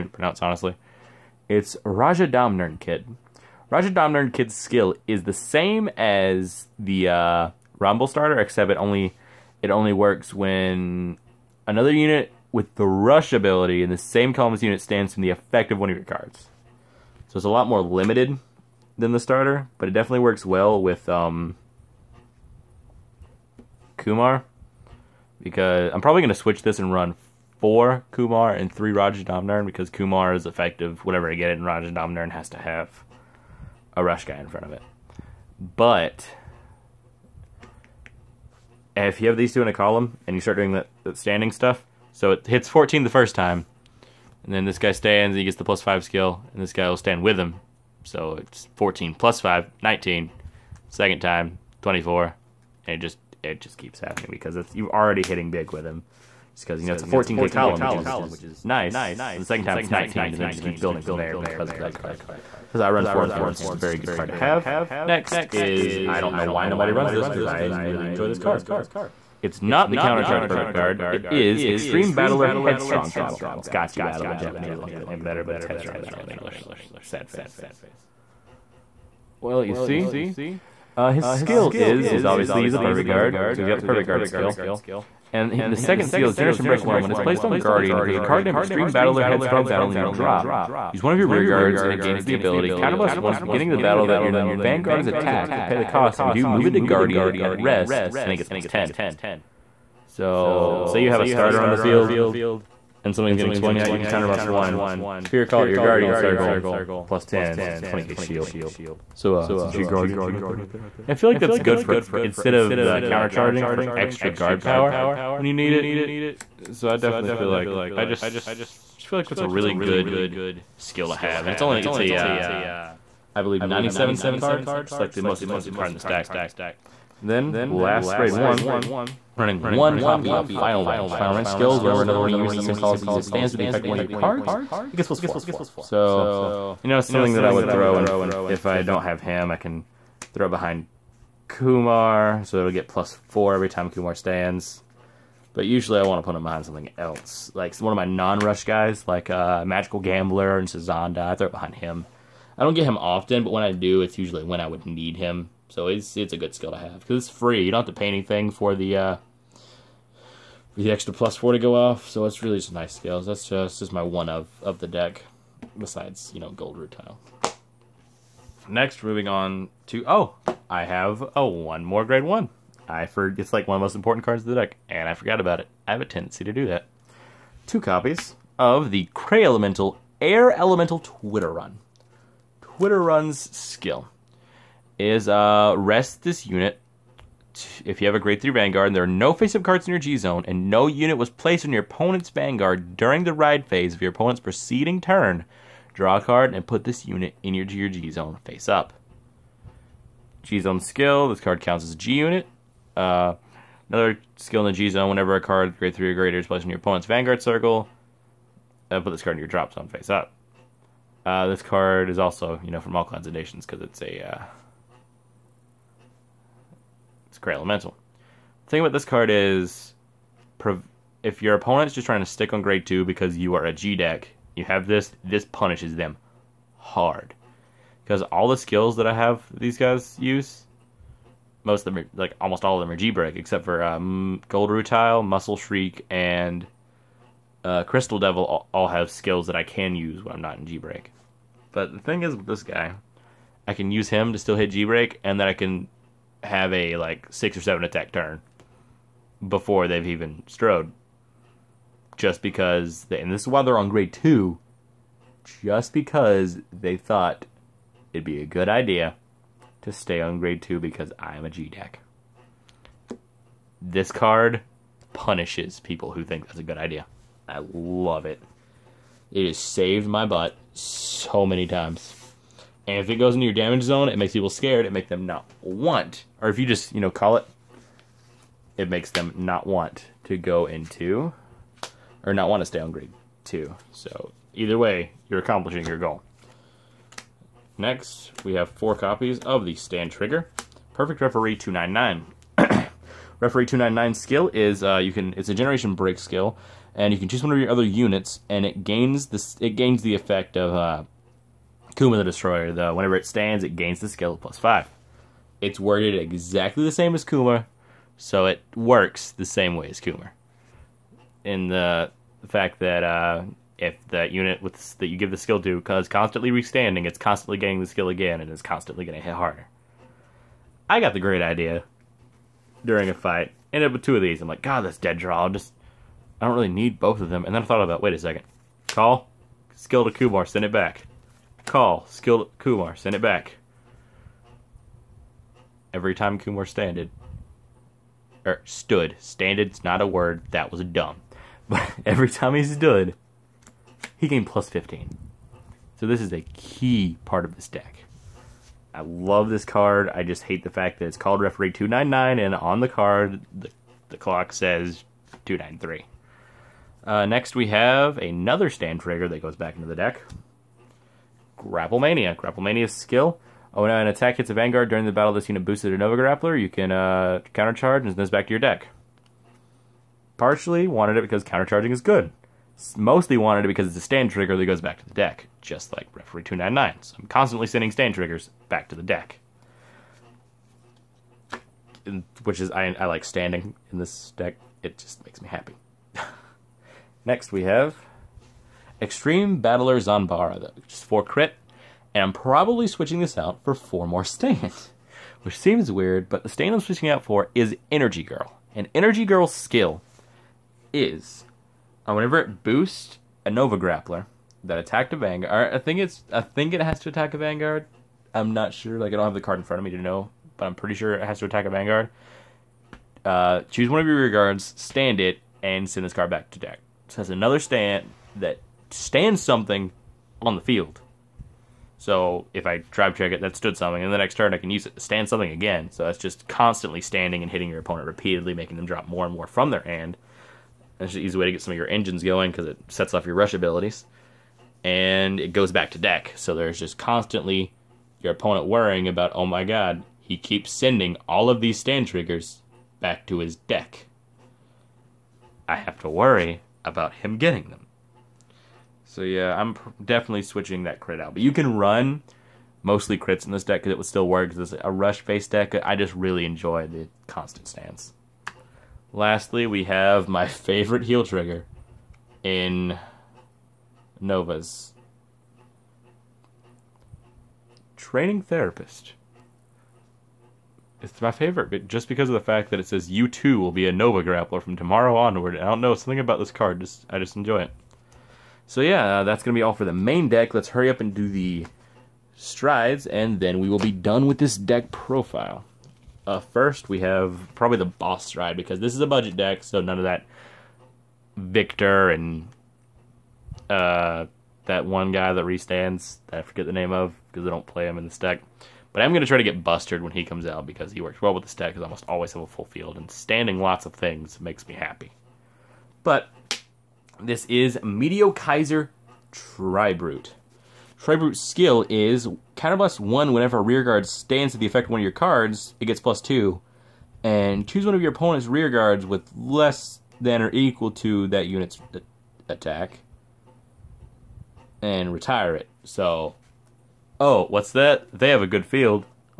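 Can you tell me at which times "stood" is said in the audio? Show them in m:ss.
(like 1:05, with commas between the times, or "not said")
5:38, 5:42, 7:03.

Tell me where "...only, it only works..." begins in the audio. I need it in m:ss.
0:08.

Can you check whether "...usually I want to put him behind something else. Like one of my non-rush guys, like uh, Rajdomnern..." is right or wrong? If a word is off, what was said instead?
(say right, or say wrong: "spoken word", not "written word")
wrong: "Magical", not "Rajdomnern".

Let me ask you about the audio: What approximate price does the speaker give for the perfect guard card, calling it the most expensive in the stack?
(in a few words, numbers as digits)
97 cents.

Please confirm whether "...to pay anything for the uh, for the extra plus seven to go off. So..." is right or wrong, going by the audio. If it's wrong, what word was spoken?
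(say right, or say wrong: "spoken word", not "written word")
wrong: "four", not "seven".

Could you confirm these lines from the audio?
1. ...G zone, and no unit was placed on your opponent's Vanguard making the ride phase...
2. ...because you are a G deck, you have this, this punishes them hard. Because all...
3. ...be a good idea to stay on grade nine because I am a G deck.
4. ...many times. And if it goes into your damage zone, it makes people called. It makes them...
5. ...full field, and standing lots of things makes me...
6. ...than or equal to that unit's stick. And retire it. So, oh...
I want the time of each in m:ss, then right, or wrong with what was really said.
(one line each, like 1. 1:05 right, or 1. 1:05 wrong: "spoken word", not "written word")
1. 3:09 wrong: "during", not "making"
2. 3:43 right
3. 4:18 wrong: "two", not "nine"
4. 4:31 wrong: "scared", not "called"
5. 8:22 right
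6. 8:40 wrong: "attack", not "stick".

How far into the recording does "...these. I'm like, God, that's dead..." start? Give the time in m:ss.
5:24.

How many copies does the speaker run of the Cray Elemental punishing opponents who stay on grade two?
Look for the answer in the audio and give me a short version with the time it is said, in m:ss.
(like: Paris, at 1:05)
2, at 2:57.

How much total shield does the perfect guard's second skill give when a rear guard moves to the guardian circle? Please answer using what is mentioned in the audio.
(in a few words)
20k.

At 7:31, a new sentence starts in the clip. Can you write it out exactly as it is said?
But you can run mostly crits in this deck because it would still work.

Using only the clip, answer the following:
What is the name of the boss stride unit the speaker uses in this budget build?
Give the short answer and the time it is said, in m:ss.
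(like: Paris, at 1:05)
Meteokaiser Tribrute, at 8:27.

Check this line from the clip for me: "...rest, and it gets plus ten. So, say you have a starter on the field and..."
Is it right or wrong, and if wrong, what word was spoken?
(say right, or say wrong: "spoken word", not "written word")
right.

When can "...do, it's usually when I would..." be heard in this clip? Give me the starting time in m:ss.
2:33.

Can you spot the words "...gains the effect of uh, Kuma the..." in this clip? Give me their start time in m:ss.
4:59.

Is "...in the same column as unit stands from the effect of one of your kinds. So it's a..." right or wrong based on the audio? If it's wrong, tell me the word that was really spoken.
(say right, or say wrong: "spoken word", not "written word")
wrong: "cards", not "kinds".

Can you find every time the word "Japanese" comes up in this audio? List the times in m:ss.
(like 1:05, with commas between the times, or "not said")
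1:14.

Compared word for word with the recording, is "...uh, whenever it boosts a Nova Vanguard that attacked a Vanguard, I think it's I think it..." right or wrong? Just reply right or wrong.
wrong.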